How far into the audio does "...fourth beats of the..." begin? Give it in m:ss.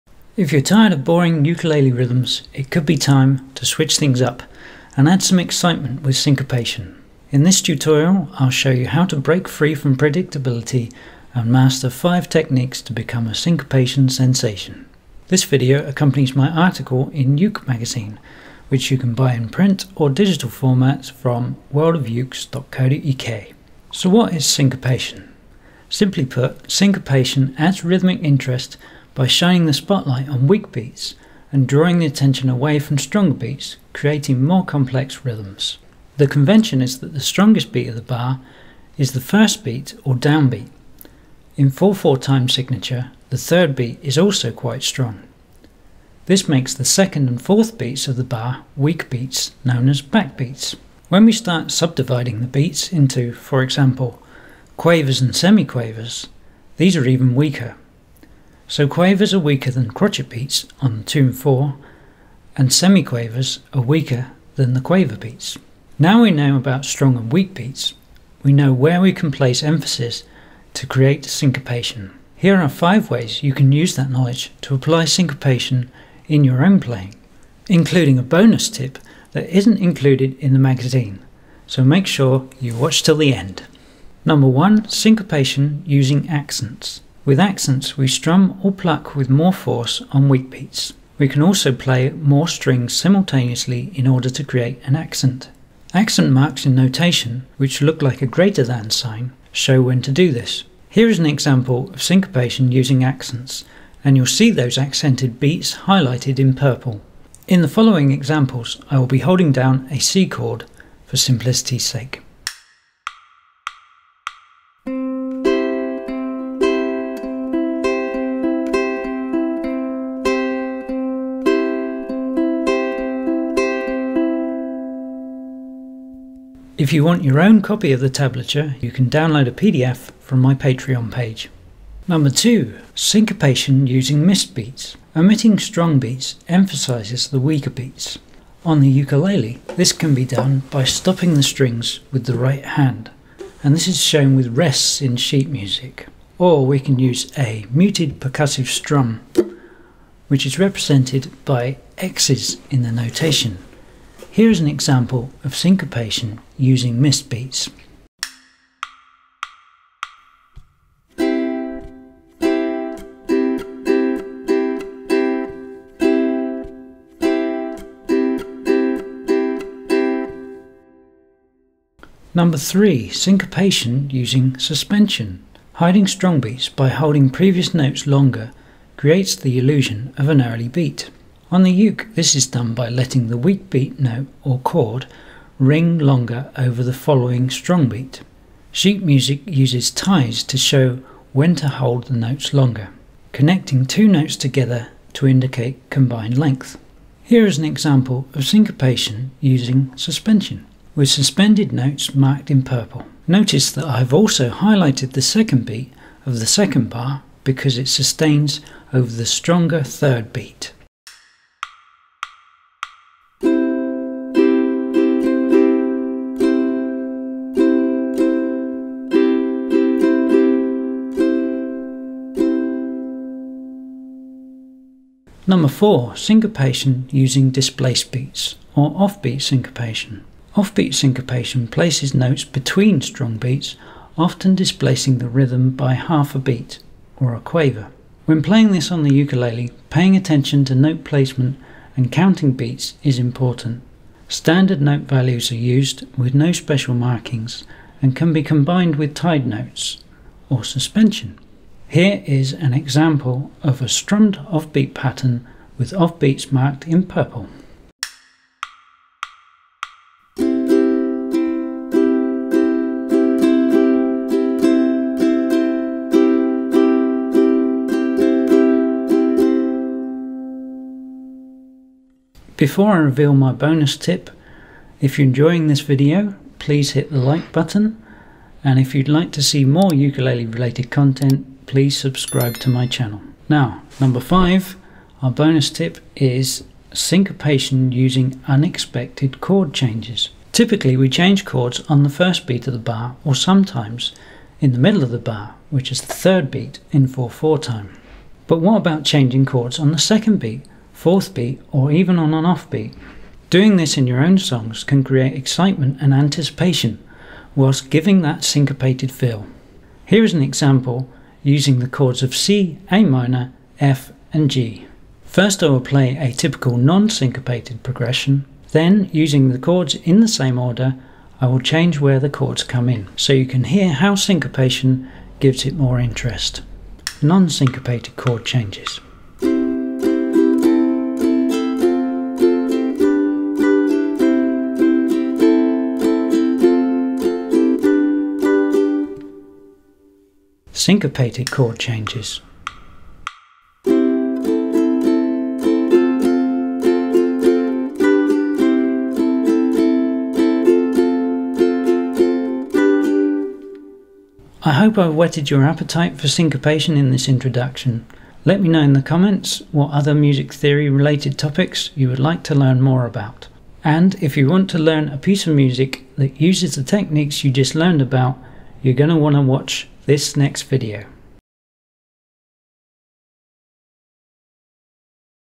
0:47.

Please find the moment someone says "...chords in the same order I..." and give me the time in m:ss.
5:19.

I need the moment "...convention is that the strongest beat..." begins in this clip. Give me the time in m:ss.
0:36.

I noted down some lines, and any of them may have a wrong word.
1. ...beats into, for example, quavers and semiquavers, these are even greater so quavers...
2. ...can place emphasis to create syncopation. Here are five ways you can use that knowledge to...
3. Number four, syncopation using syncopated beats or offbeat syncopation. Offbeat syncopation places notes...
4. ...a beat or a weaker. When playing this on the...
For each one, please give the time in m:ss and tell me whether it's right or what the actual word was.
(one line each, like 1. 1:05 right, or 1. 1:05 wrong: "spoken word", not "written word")
1. 0:52 wrong: "weaker", not "greater"
2. 1:09 right
3. 3:45 wrong: "displaced", not "syncopated"
4. 3:56 wrong: "quaver", not "weaker".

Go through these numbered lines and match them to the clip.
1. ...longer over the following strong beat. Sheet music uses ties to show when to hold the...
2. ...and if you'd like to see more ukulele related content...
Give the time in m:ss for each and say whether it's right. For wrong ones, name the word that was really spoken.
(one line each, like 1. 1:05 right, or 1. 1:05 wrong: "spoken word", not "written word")
1. 3:05 right
2. 4:38 right.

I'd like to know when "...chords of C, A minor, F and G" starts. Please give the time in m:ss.
5:11.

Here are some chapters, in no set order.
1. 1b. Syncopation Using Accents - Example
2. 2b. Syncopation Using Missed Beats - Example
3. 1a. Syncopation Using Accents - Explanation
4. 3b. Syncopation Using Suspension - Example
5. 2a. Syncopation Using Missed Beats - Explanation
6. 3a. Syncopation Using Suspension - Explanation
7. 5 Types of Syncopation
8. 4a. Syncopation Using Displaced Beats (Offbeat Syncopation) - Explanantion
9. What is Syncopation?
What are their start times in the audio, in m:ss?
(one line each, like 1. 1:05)
1. 1:52
2. 2:38
3. 1:24
4. 3:31
5. 2:12
6. 2:52
7. 1:13
8. 3:45
9. 0:23.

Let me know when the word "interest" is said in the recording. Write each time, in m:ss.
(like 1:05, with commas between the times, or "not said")
0:28, 5:25.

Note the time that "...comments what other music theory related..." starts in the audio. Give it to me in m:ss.
5:59.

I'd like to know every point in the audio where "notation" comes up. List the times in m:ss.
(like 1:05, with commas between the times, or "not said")
1:36, 2:32.